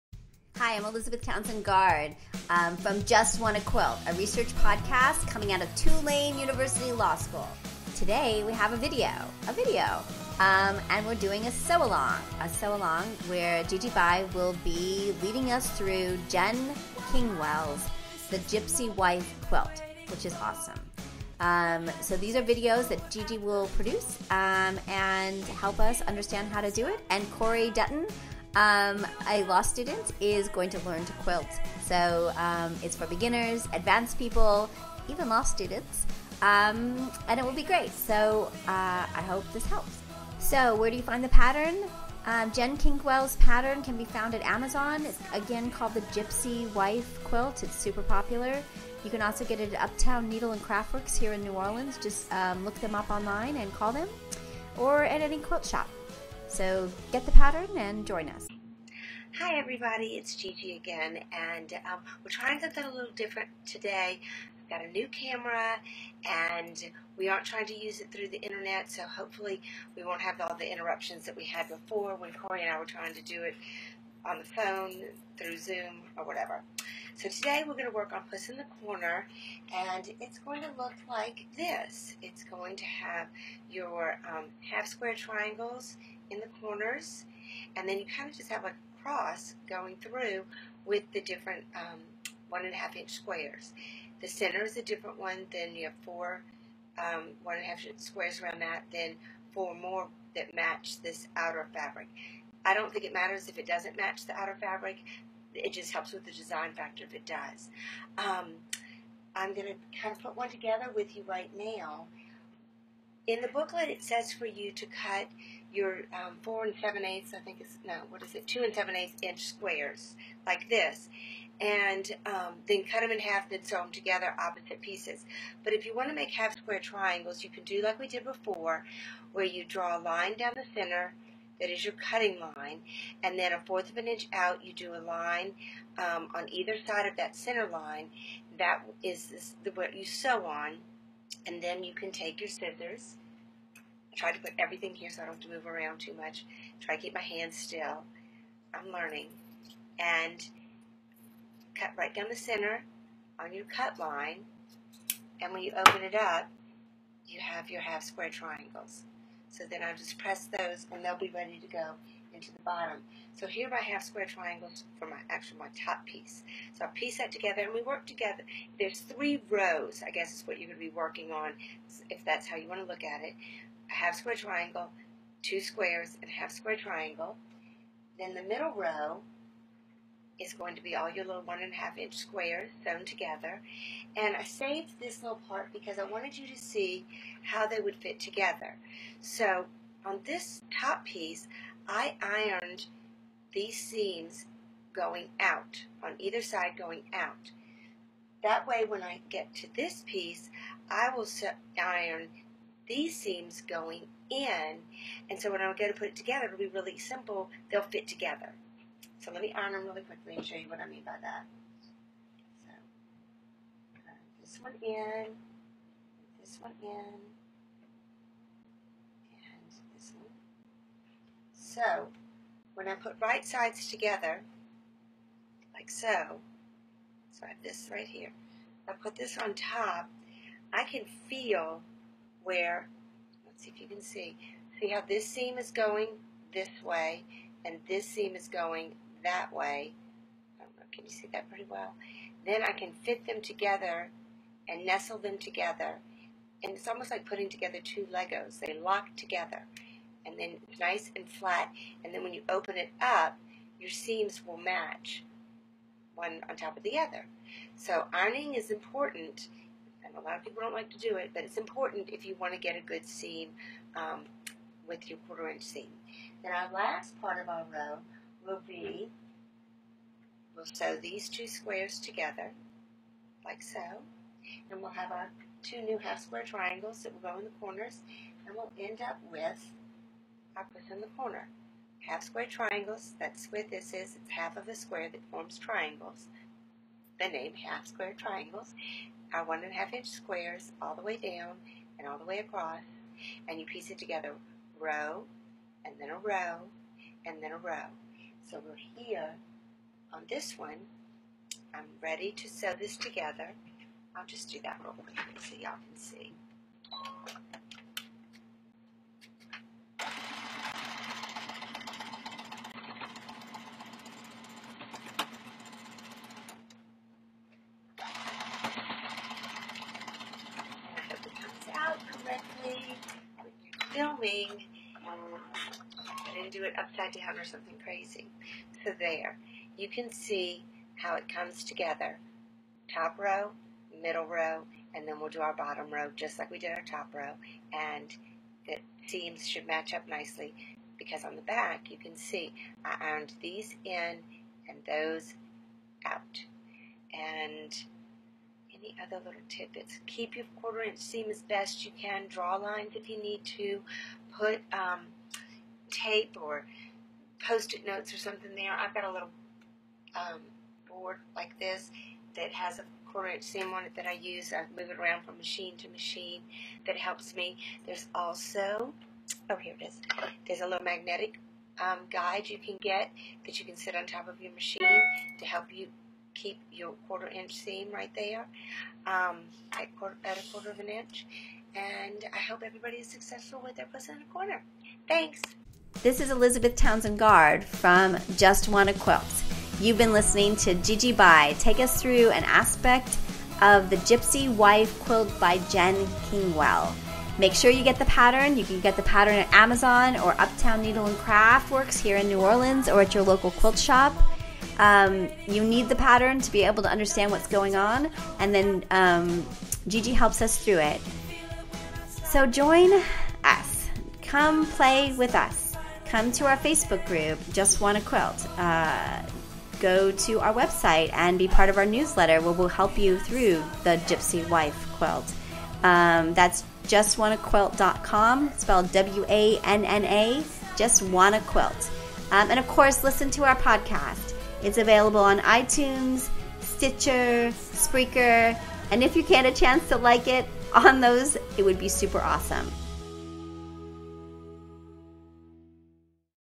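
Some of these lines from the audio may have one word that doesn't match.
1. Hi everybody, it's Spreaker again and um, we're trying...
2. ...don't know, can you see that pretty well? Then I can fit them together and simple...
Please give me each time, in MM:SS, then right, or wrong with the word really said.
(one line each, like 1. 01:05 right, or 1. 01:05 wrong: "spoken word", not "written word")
1. 00:59 wrong: "Gigi", not "Spreaker"
2. 04:00 wrong: "nestle", not "simple".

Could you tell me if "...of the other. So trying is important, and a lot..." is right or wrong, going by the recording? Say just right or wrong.
wrong.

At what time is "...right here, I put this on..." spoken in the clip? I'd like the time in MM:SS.
03:47.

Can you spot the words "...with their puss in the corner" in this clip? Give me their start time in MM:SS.
06:23.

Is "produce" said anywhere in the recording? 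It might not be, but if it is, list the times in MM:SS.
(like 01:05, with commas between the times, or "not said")
00:23.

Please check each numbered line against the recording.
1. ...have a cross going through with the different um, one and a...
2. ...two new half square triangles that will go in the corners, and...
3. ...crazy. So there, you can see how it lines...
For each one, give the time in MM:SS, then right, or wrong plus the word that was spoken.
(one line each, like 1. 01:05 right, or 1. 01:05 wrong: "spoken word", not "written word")
1. 01:28 right
2. 04:35 right
3. 05:27 wrong: "comes", not "lines".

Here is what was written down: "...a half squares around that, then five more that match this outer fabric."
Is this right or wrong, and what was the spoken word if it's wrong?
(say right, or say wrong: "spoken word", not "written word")
wrong: "four", not "five".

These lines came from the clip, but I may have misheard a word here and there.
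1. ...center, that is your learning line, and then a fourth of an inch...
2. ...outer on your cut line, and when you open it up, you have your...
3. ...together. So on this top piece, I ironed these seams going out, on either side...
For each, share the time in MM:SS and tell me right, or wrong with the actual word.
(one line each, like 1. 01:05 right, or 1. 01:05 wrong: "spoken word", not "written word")
1. 02:10 wrong: "cutting", not "learning"
2. 02:32 wrong: "center", not "outer"
3. 03:08 right.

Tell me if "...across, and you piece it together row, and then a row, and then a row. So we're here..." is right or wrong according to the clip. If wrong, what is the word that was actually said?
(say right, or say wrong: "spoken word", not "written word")
right.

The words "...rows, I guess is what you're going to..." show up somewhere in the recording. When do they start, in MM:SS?
02:49.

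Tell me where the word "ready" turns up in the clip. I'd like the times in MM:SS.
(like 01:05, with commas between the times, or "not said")
02:41, 05:02.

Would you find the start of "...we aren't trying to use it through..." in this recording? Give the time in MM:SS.
01:07.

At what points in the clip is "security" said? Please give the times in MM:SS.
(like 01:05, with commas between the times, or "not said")
not said.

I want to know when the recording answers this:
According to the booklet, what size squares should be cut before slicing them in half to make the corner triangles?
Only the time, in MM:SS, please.
01:58.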